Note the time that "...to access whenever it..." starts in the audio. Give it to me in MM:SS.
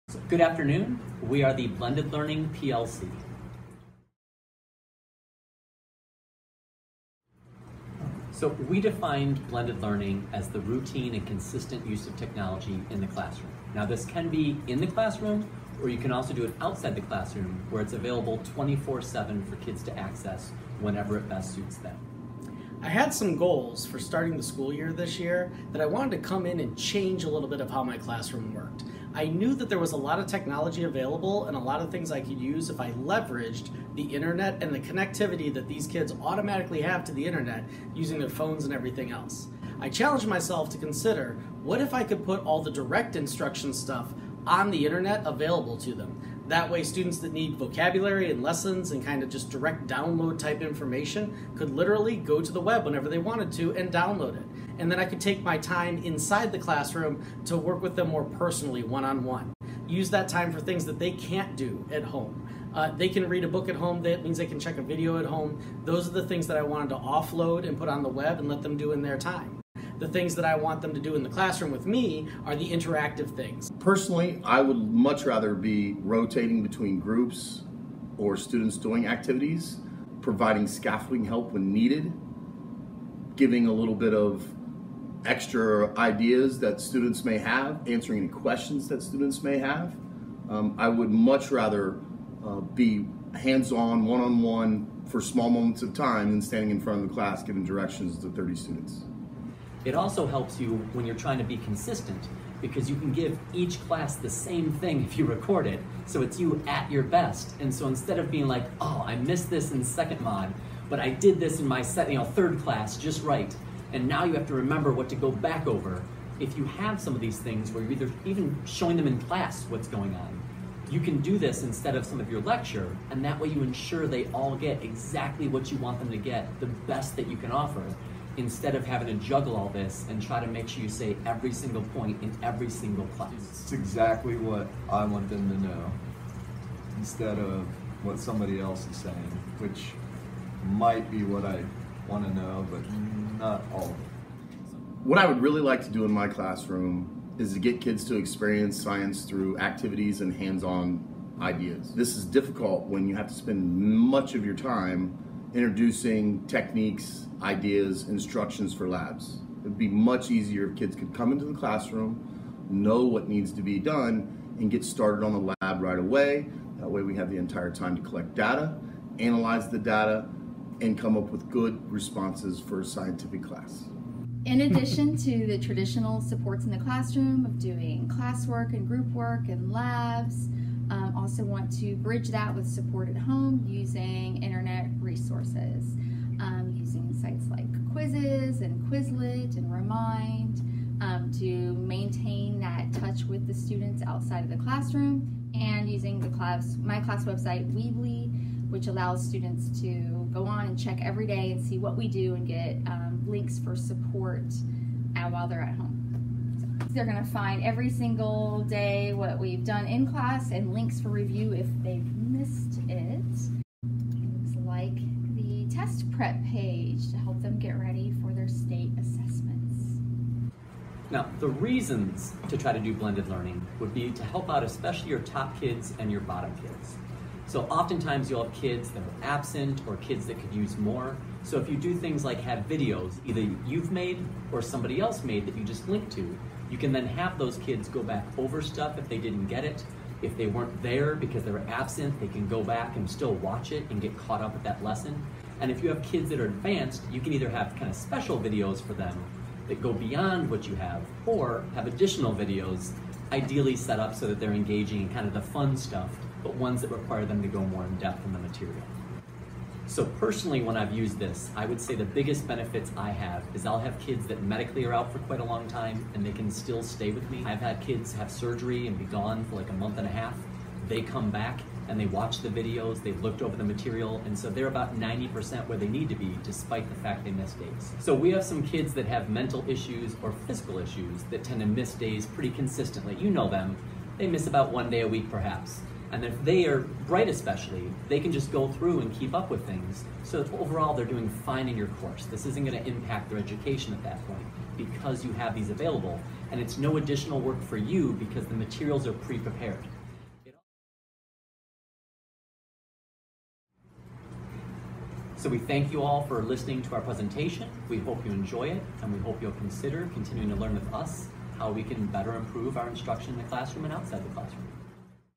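00:19.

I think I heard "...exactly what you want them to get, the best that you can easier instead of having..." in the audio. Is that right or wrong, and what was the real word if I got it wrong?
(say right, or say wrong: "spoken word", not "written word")
wrong: "offer", not "easier".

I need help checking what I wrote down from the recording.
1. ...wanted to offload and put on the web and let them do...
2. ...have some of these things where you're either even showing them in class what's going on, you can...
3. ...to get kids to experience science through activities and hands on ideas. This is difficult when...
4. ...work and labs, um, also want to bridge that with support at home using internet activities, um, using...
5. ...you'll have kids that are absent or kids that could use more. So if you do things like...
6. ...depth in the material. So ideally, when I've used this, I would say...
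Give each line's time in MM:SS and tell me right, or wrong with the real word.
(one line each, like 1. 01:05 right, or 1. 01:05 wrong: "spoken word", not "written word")
1. 01:06 right
2. 01:56 right
3. 02:27 right
4. 02:59 wrong: "resources", not "activities"
5. 03:48 right
6. 04:17 wrong: "personally", not "ideally".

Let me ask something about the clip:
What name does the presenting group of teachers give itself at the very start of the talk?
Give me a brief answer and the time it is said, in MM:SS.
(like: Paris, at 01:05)
Blended Learning PLC, at 00:01.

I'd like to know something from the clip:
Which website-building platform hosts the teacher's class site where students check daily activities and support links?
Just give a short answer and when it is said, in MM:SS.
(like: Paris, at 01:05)
Weebly, at 03:17.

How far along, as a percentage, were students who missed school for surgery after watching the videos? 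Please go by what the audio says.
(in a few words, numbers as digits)
90%.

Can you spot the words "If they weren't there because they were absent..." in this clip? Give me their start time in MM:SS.
04:00.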